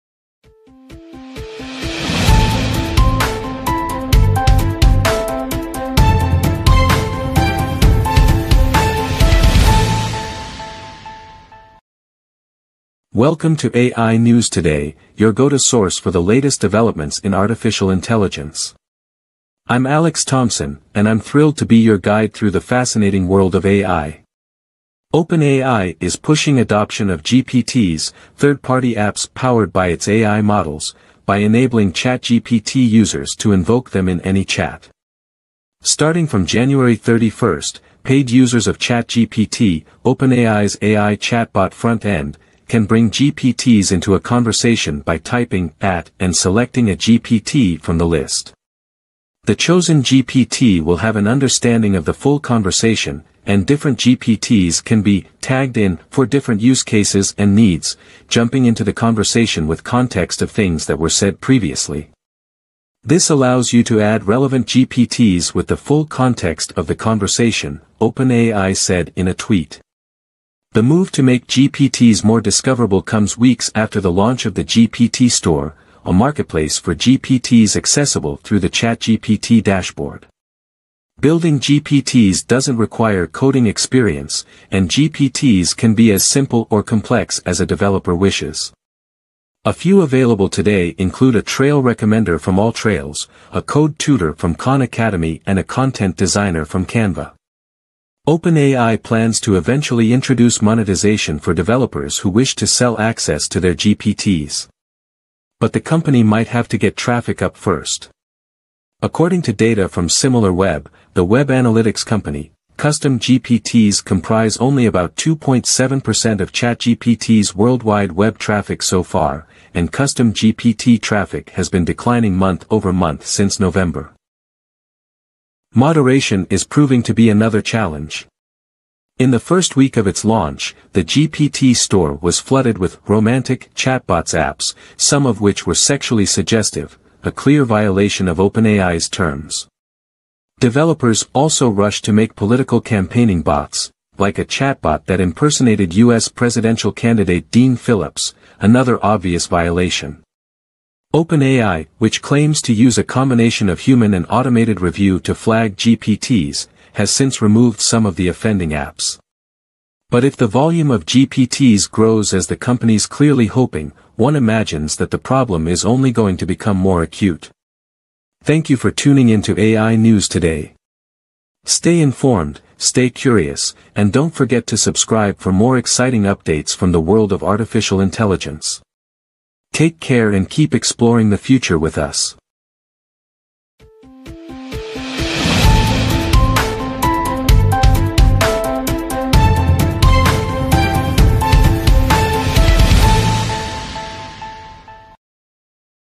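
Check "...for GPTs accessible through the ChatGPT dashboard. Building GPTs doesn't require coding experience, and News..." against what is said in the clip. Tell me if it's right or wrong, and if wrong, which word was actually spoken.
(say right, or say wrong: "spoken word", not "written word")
wrong: "GPTs", not "News".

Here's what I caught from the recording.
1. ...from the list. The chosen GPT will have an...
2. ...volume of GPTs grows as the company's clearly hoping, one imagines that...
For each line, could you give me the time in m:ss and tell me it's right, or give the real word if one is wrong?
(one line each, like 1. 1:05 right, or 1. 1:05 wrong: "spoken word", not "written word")
1. 0:47 right
2. 2:40 right.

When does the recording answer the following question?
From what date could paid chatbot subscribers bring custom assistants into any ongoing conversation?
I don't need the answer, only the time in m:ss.
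0:36.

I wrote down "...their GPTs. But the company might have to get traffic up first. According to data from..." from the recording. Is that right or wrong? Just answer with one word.
right.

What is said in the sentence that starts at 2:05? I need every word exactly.
Moderation is proving to be another challenge.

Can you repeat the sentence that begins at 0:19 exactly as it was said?
I'm Alex Thompson, and I'm thrilled to be your guide through the fascinating world of AI.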